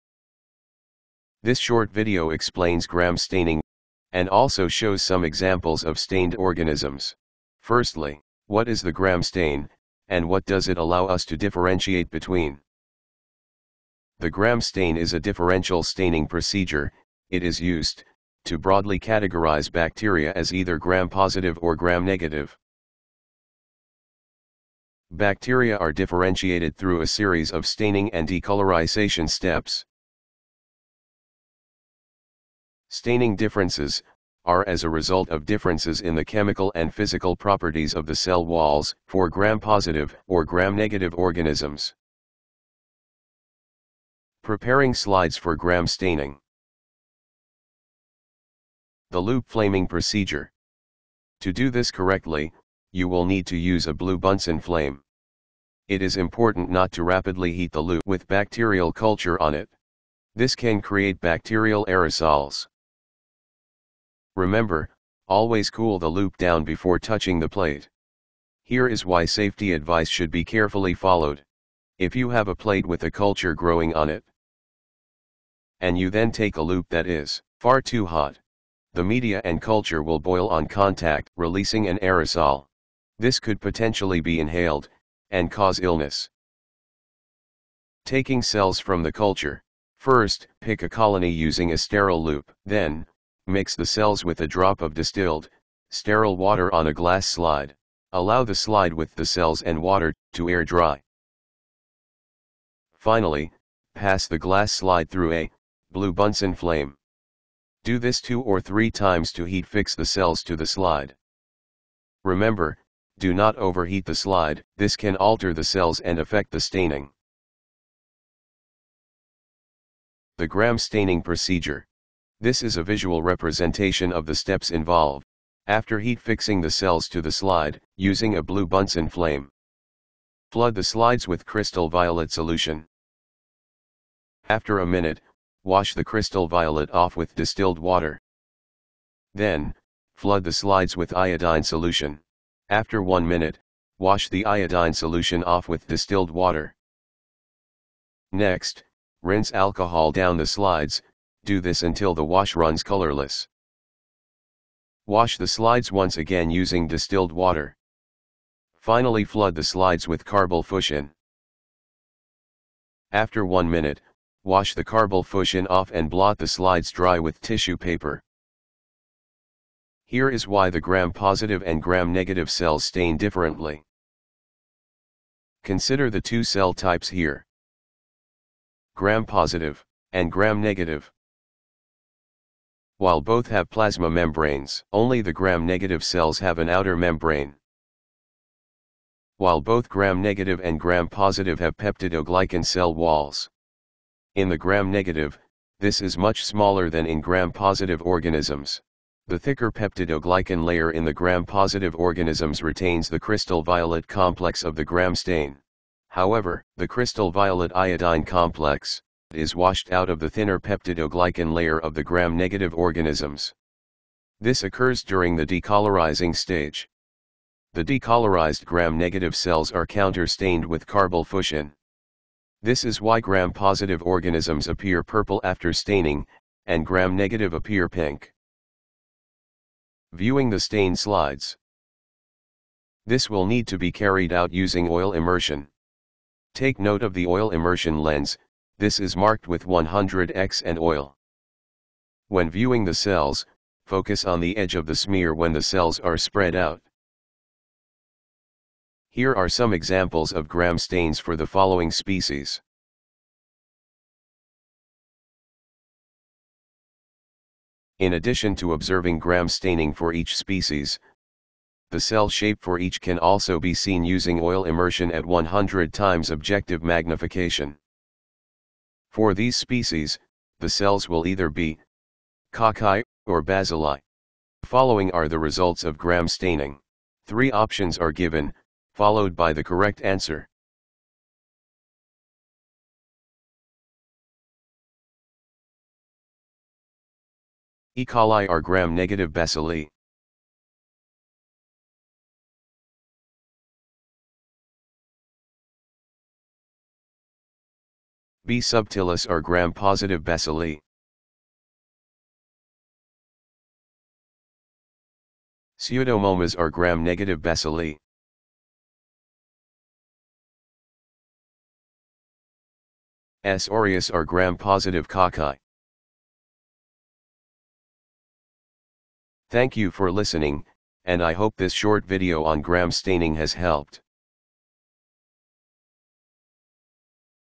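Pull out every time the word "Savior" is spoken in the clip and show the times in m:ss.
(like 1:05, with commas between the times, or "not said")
not said.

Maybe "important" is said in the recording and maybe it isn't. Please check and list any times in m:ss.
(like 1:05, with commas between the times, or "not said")
0:56.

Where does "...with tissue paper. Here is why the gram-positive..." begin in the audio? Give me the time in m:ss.
2:47.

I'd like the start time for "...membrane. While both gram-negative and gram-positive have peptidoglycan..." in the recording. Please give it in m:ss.
3:06.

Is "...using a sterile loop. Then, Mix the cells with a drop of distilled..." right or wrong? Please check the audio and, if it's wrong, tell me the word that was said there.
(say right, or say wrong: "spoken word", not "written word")
right.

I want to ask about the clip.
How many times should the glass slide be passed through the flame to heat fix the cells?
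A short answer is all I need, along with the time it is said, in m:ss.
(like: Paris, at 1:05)
2 or 3, at 1:48.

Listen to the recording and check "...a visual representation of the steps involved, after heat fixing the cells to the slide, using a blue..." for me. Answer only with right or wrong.
right.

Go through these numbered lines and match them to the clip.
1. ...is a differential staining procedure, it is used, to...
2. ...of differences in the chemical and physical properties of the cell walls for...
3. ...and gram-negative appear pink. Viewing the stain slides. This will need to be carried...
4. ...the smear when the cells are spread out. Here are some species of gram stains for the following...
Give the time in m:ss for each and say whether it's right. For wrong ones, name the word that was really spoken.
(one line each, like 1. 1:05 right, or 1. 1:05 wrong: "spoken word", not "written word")
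1. 0:14 right
2. 0:35 right
3. 3:46 right
4. 4:04 wrong: "examples", not "species".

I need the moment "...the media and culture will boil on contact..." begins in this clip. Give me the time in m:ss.
1:18.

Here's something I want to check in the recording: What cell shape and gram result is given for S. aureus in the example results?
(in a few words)
Gram-positive cocci.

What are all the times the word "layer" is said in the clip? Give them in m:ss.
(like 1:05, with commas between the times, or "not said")
3:20, 3:31.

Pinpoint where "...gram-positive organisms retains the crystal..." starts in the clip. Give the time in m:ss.
3:21.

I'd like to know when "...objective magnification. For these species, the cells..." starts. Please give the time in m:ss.
4:26.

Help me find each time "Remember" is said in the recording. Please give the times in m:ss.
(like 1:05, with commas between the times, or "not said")
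1:04, 1:52.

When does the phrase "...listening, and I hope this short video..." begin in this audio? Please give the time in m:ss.
5:20.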